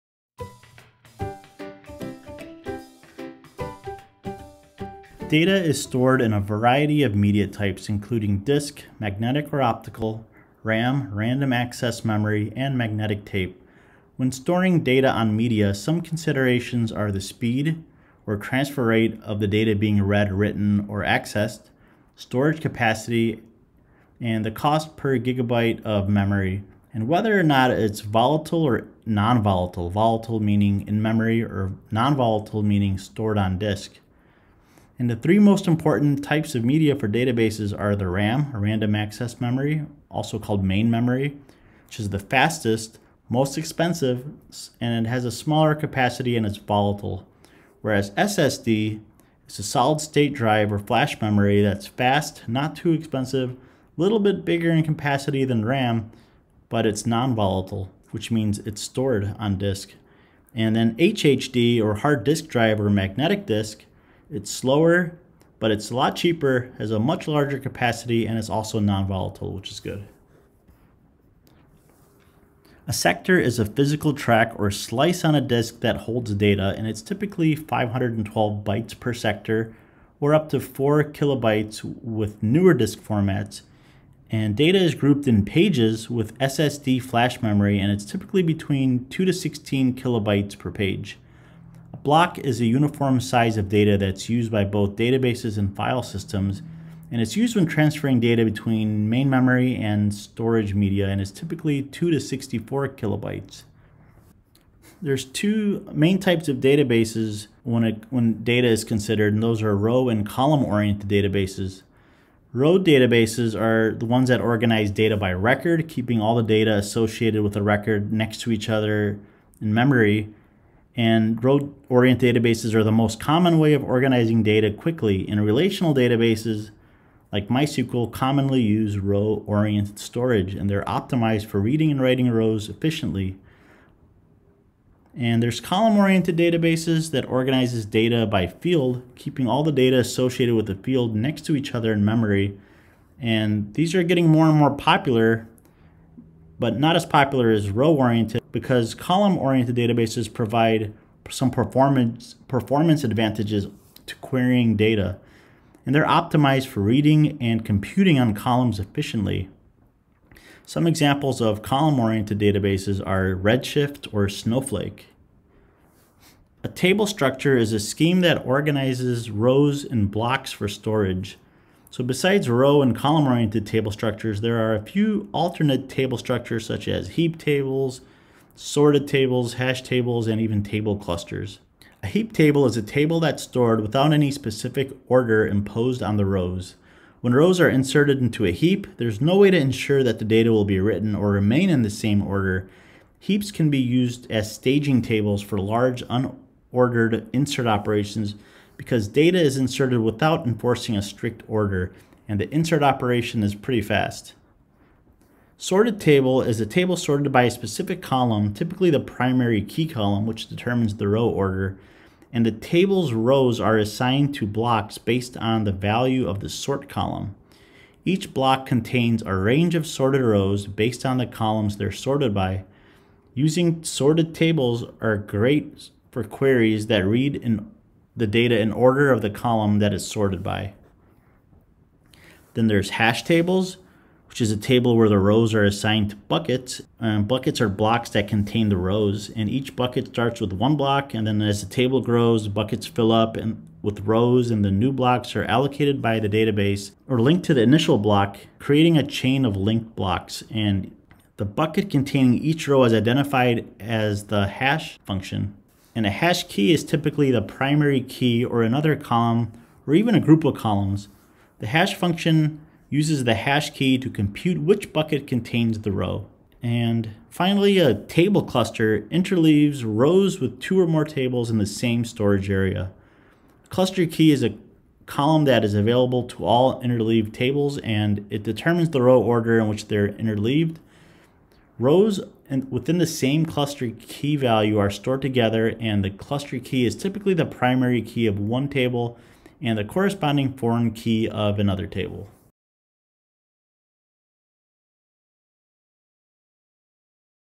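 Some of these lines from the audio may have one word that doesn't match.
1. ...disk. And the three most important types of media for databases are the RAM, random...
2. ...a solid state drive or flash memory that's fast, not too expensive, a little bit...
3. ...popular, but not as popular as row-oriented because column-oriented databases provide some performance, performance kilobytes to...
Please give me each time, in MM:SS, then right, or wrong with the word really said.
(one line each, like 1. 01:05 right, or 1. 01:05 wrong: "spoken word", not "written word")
1. 00:33 right
2. 00:49 right
3. 02:24 wrong: "advantages", not "kilobytes".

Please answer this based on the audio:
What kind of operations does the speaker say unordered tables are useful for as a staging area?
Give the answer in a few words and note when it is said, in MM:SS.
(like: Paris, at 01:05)
large unordered insert operations, at 03:15.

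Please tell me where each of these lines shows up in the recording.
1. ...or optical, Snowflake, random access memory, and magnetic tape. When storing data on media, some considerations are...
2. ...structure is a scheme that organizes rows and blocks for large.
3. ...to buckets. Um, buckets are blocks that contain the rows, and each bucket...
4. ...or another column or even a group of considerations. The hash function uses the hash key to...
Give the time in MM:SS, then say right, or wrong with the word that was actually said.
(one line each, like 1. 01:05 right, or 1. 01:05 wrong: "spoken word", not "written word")
1. 00:09 wrong: "RAM", not "Snowflake"
2. 02:47 wrong: "storage", not "large"
3. 03:56 right
4. 04:18 wrong: "columns", not "considerations".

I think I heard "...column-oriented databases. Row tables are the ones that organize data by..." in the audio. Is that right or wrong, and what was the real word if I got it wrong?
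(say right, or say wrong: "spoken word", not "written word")
wrong: "databases", not "tables".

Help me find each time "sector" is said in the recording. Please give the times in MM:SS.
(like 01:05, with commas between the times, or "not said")
01:12, 01:19.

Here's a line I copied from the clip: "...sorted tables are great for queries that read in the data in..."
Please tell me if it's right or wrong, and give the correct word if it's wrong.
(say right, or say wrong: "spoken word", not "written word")
right.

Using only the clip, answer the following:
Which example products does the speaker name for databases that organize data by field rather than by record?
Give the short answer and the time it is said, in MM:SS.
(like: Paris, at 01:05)
Redshift or Snowflake, at 02:43.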